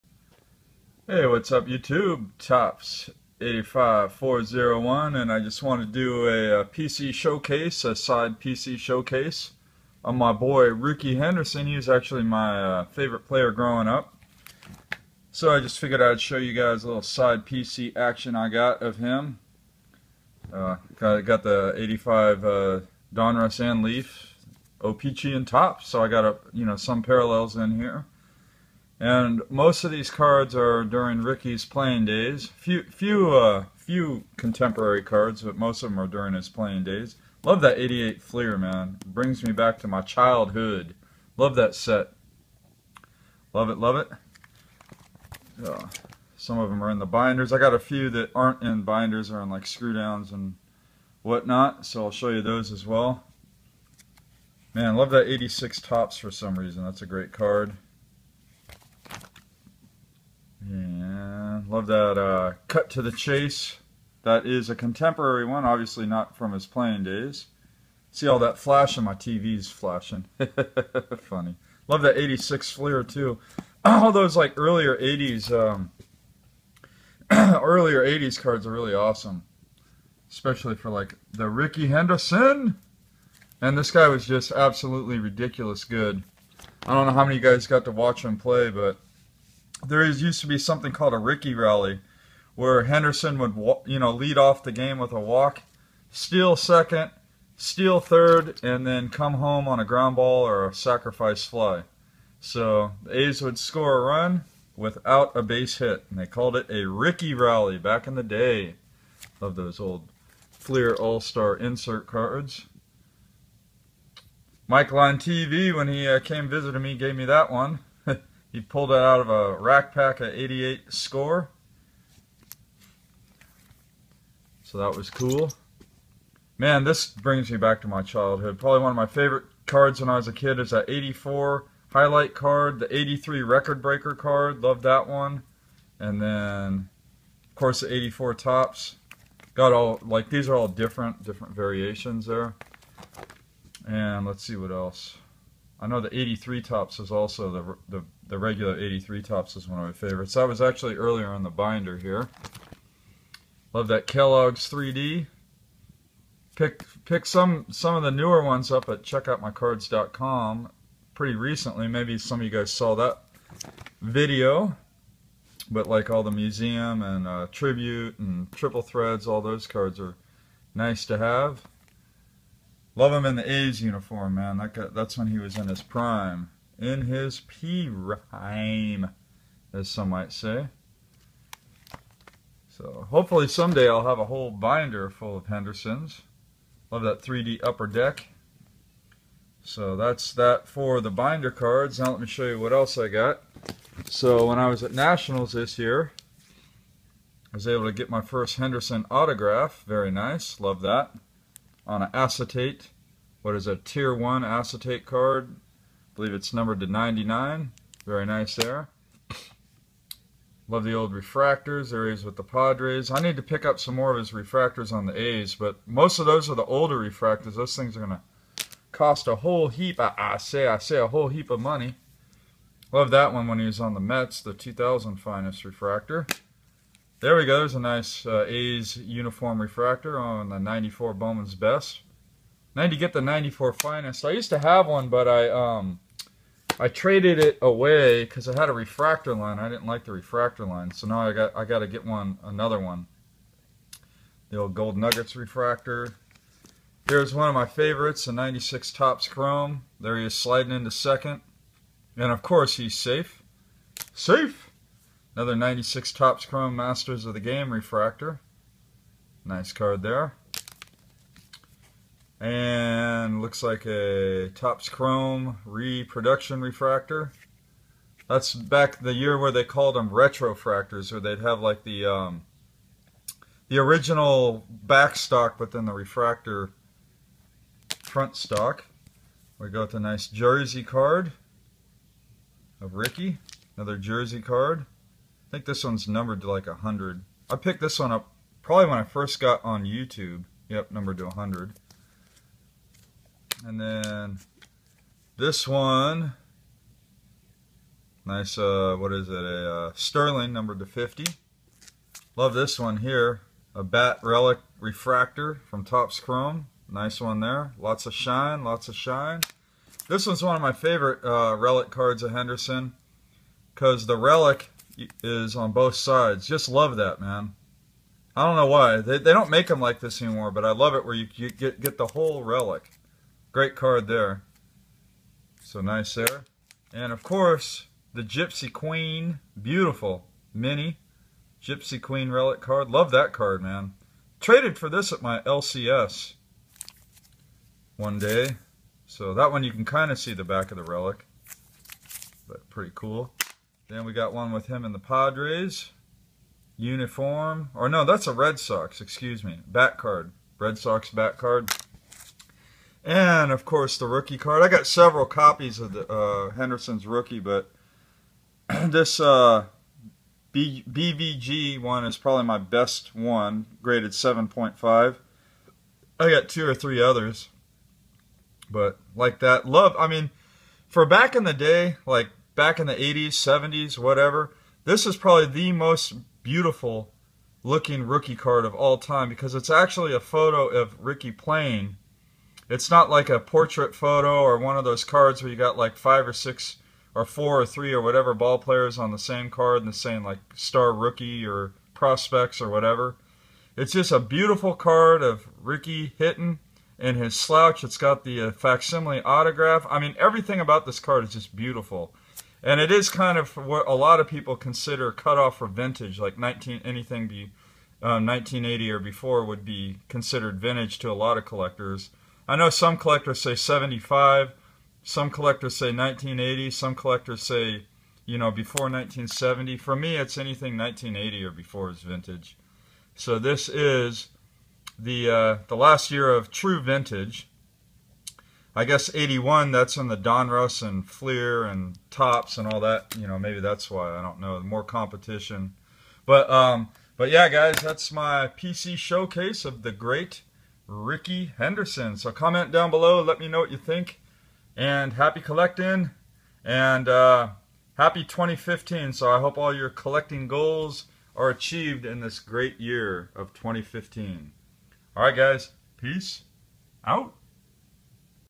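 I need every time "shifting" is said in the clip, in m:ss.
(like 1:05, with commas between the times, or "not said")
not said.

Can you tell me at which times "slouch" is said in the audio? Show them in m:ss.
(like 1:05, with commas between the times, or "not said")
6:37.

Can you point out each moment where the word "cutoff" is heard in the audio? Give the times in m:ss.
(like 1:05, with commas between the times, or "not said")
6:45.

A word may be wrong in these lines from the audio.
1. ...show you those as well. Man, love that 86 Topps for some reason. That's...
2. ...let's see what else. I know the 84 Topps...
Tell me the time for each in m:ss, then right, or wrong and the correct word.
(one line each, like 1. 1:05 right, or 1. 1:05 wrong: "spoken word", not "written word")
1. 0:52 right
2. 2:24 wrong: "83", not "84".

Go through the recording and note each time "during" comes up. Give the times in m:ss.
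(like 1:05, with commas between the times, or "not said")
0:30, 0:36.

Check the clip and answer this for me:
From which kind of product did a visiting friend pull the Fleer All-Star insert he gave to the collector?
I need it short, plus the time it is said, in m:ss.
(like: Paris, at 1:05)
rack pack, at 1:59.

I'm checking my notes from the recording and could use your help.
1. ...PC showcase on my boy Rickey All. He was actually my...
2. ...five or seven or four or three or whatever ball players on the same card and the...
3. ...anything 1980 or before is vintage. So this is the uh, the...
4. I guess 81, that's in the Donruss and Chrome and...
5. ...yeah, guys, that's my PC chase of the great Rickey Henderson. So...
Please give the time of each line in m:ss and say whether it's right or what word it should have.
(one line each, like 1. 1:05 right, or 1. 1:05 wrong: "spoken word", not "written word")
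1. 0:08 wrong: "Henderson", not "All"
2. 6:25 wrong: "six", not "seven"
3. 7:00 right
4. 7:08 wrong: "Fleer", not "Chrome"
5. 7:17 wrong: "showcase", not "chase".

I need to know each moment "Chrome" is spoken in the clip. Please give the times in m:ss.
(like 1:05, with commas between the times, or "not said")
4:09, 4:16, 4:24, 5:06.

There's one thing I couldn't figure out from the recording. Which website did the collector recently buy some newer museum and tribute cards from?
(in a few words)
checkoutmycards.com.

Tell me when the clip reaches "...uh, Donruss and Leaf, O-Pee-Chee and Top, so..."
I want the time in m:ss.
0:22.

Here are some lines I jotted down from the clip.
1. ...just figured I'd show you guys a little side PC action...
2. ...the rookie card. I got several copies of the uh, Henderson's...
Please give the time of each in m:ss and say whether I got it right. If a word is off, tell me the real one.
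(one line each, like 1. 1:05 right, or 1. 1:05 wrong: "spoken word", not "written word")
1. 0:15 right
2. 5:53 right.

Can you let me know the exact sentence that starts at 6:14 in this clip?
This is probably the most beautiful looking rookie card of all time because it's actually a photo of Rickey playing.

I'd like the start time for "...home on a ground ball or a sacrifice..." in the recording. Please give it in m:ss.
1:39.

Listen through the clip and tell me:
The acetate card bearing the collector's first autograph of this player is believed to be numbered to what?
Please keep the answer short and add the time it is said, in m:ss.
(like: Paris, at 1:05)
99, at 3:26.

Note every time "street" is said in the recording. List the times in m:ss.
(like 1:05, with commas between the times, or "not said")
not said.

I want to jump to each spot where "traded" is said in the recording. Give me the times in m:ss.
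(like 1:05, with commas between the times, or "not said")
3:56, 5:34.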